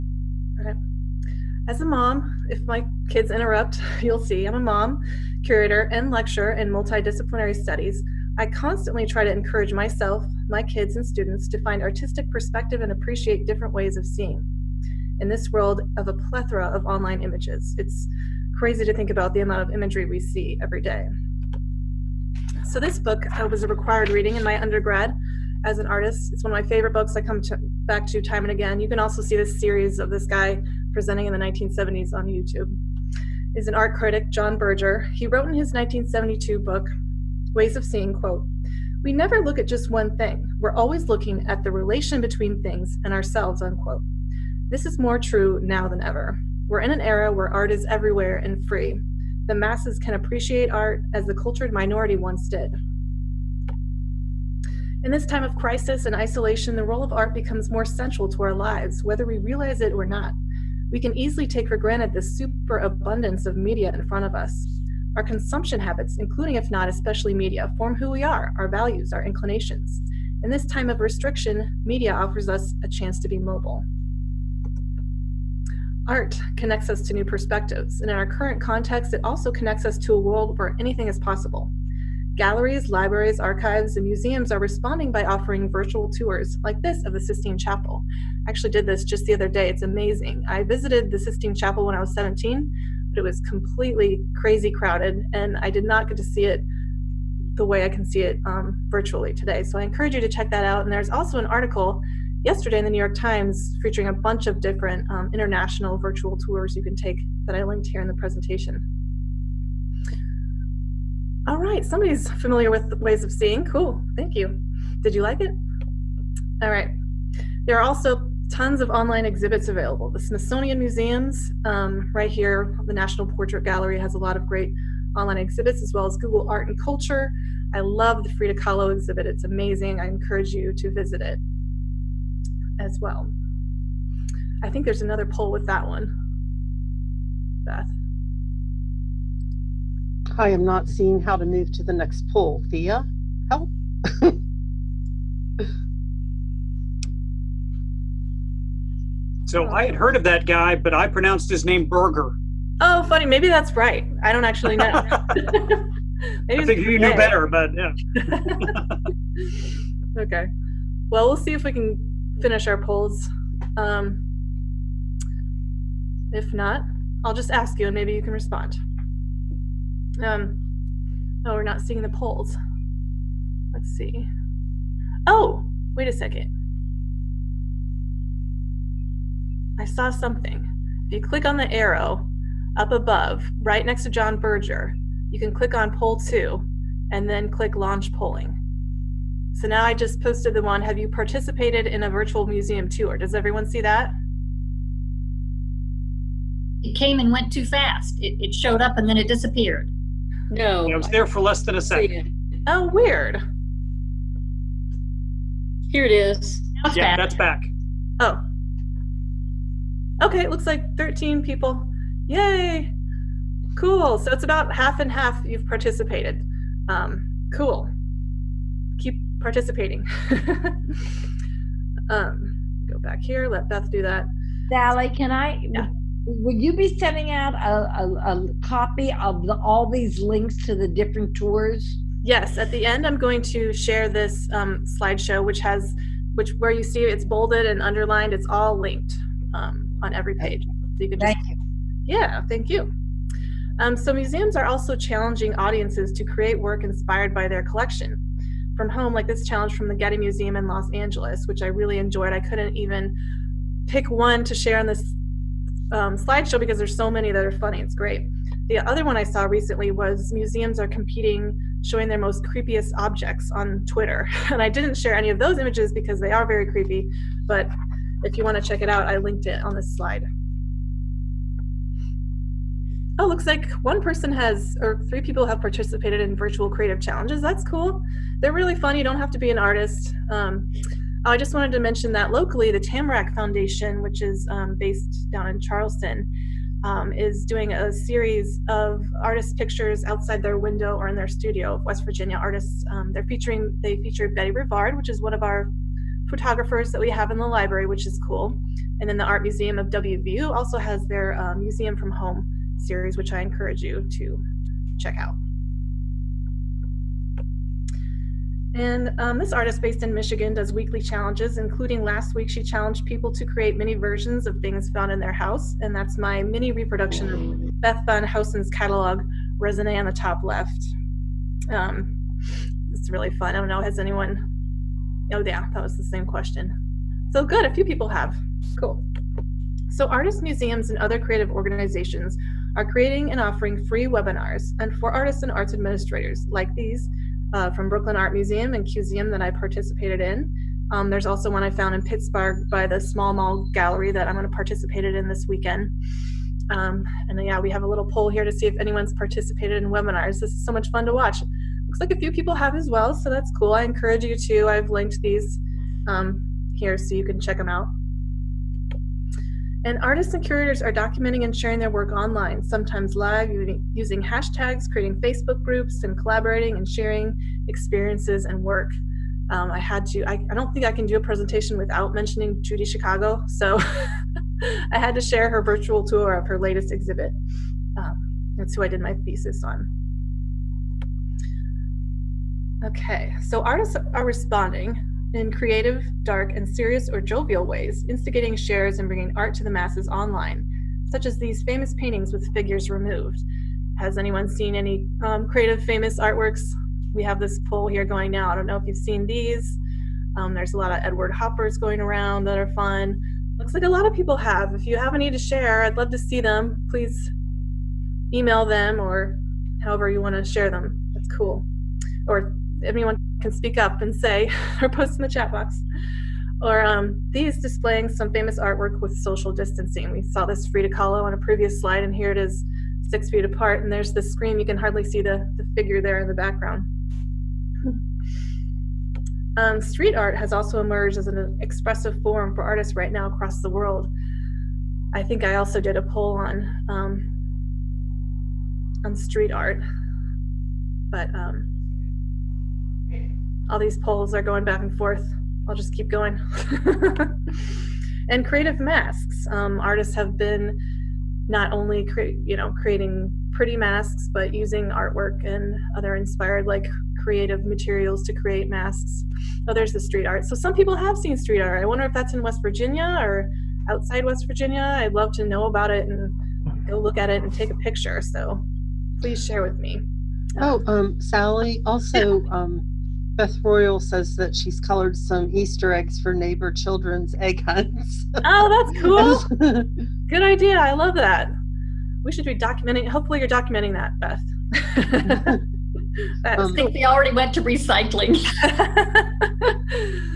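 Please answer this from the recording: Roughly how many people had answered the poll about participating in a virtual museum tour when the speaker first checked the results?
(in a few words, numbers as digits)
13.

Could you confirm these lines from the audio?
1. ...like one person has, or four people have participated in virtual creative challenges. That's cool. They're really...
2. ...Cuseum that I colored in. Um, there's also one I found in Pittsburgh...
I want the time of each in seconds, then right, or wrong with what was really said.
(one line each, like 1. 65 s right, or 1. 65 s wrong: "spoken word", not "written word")
1. 273 s wrong: "three", not "four"
2. 338 s wrong: "participated", not "colored".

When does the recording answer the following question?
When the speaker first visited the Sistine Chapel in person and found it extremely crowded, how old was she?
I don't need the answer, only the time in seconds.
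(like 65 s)
92 s.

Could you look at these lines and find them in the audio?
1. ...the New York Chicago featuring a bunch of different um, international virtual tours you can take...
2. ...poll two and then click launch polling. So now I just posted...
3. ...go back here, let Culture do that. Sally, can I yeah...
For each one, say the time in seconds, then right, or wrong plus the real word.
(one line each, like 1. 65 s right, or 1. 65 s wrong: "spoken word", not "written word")
1. 102 s wrong: "Times", not "Chicago"
2. 185 s right
3. 222 s wrong: "Beth", not "Culture".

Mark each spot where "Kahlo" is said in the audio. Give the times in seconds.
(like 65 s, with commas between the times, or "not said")
128 s, 420 s.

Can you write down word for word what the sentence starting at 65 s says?
Our consumption habits, including if not especially media, form who we are, our values, our inclinations.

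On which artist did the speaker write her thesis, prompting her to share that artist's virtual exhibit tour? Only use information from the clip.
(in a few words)
Judy Chicago.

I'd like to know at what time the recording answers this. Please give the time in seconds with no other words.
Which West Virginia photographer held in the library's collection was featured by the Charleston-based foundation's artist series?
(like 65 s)
294 s.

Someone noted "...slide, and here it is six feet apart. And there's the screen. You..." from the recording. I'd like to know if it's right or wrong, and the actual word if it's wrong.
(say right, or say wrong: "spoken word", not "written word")
right.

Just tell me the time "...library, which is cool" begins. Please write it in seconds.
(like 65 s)
297 s.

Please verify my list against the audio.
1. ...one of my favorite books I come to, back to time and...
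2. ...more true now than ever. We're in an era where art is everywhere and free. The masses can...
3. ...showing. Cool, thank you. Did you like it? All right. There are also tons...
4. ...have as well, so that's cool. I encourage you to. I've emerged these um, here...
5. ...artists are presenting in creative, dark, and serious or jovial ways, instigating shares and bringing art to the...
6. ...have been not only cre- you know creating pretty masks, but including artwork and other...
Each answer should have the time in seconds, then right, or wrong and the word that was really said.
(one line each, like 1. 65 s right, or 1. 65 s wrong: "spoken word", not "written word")
1. 26 s right
2. 44 s right
3. 113 s wrong: "seeing", not "showing"
4. 352 s wrong: "linked", not "emerged"
5. 383 s wrong: "responding", not "presenting"
6. 450 s wrong: "using", not "including".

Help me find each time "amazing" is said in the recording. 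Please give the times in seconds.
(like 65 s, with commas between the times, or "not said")
89 s, 129 s.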